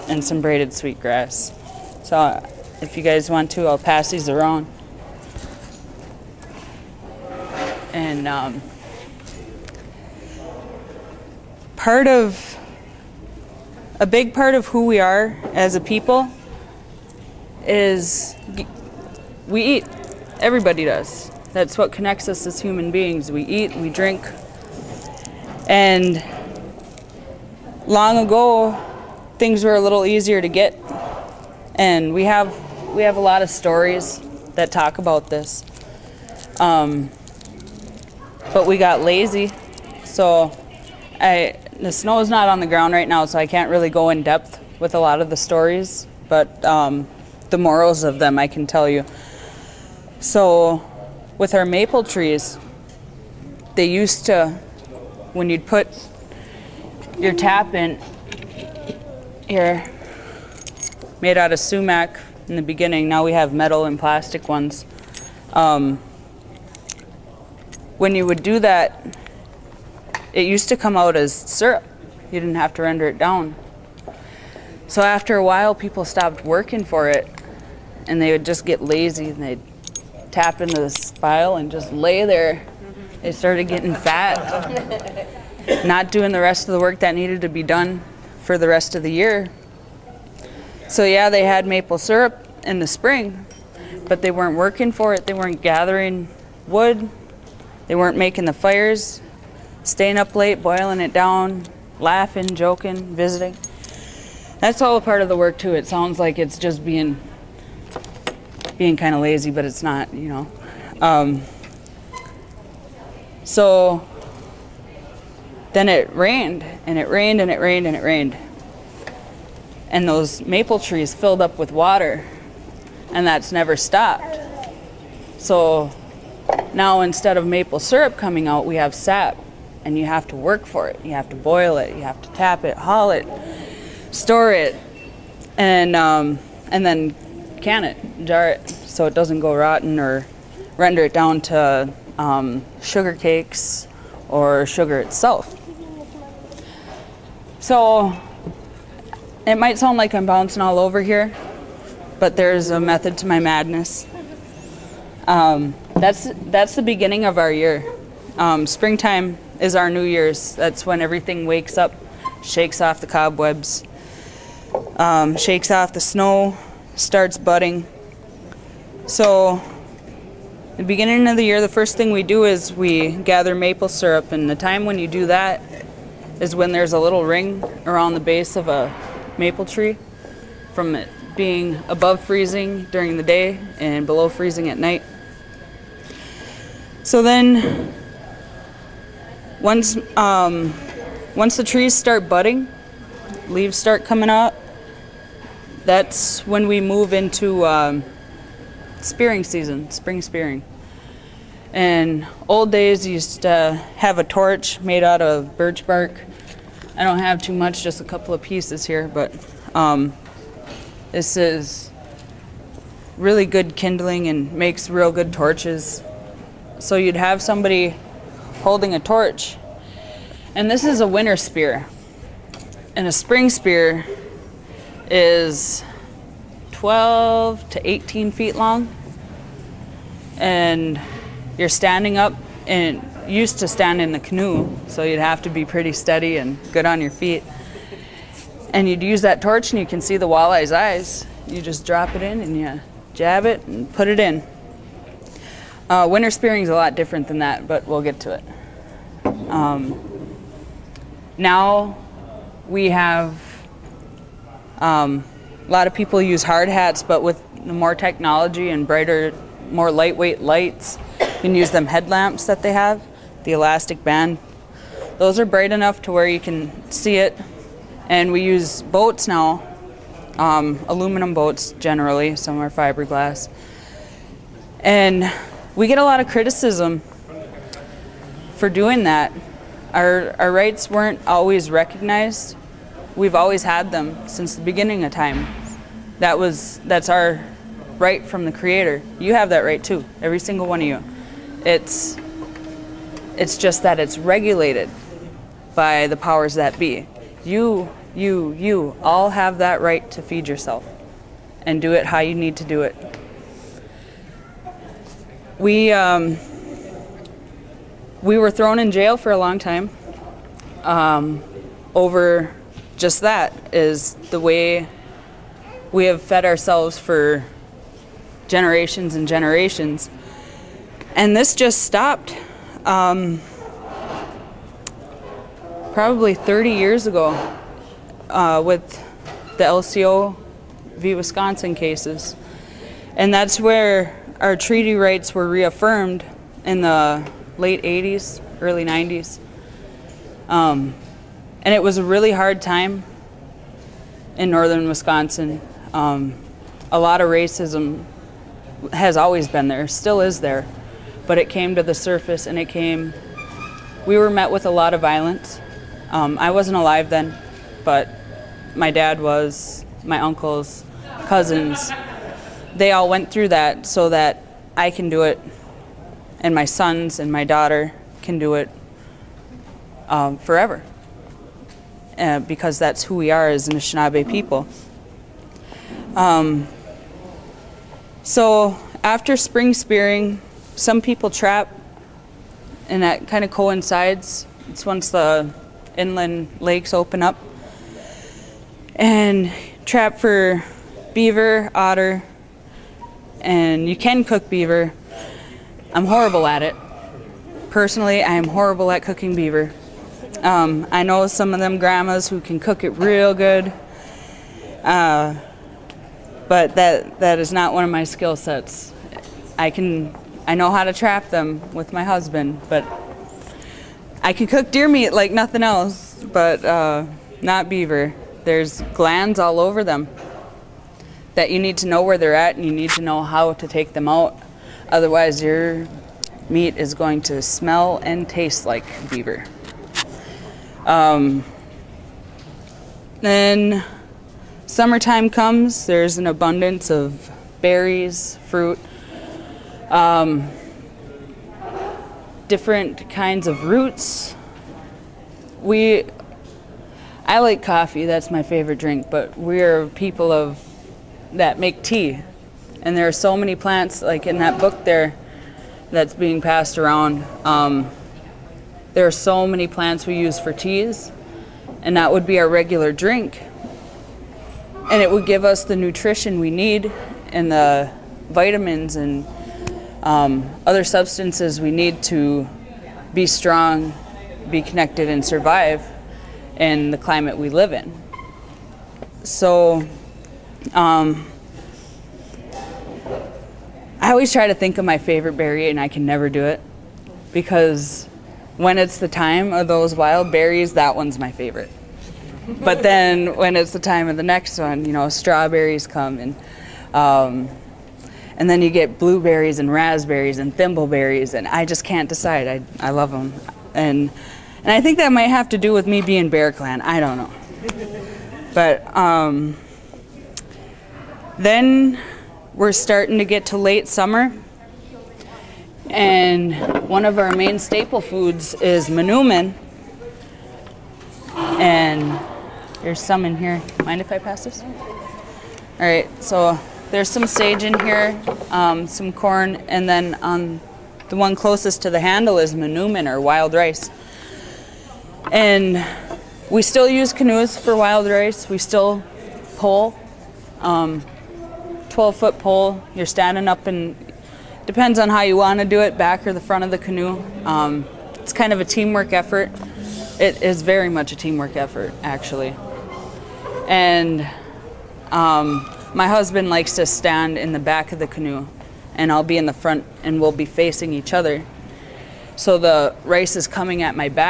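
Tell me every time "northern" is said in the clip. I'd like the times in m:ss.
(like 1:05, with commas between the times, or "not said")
5:44.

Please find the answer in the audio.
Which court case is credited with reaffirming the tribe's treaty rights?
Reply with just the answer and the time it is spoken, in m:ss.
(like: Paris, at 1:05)
LCO v. Wisconsin, at 5:29.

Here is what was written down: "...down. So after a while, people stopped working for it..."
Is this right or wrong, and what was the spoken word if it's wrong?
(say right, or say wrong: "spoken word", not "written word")
right.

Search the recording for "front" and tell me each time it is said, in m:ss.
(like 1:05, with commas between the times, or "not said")
9:06, 9:19.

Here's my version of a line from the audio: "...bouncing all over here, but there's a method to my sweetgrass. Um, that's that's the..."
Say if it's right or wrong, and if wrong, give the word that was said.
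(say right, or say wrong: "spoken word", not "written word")
wrong: "madness", not "sweetgrass".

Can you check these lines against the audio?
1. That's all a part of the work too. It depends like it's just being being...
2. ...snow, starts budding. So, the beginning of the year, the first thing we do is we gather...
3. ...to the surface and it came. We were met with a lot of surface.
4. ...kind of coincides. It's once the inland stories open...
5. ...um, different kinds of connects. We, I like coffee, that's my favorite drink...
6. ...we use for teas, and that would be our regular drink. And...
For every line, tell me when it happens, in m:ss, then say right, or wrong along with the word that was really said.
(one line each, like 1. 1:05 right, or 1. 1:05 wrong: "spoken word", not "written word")
1. 1:44 wrong: "sounds", not "depends"
2. 2:45 right
3. 5:51 wrong: "violence", not "surface"
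4. 6:23 wrong: "lakes", not "stories"
5. 7:19 wrong: "roots", not "connects"
6. 7:40 right.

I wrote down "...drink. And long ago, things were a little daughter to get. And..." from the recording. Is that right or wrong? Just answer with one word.
wrong.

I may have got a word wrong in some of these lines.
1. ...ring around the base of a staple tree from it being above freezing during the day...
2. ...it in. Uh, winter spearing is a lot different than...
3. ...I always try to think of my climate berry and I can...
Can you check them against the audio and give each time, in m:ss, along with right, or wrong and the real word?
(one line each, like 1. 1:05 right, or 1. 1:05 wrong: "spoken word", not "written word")
1. 2:57 wrong: "maple", not "staple"
2. 4:04 right
3. 8:03 wrong: "favorite", not "climate".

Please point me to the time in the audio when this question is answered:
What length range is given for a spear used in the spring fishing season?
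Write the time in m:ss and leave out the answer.
3:46.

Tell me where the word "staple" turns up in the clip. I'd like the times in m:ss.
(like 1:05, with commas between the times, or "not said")
8:37.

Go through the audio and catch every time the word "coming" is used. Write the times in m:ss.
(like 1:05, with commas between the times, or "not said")
2:08, 3:14, 9:23.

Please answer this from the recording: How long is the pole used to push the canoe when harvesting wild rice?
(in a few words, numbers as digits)
12 foot.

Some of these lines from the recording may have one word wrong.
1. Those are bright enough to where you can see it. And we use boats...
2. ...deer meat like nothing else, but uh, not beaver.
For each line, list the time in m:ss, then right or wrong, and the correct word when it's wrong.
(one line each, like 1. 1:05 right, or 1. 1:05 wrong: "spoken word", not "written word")
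1. 4:25 right
2. 6:54 right.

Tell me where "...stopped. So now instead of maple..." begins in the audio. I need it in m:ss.
2:03.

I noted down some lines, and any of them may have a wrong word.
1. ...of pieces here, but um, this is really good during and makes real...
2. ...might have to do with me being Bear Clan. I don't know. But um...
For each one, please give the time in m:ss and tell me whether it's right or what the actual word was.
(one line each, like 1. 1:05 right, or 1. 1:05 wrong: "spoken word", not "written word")
1. 3:28 wrong: "kindling", not "during"
2. 8:25 right.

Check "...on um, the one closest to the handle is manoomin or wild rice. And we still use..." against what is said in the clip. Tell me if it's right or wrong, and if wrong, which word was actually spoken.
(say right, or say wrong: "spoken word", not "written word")
right.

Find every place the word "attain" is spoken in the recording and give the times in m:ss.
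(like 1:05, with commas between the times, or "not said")
not said.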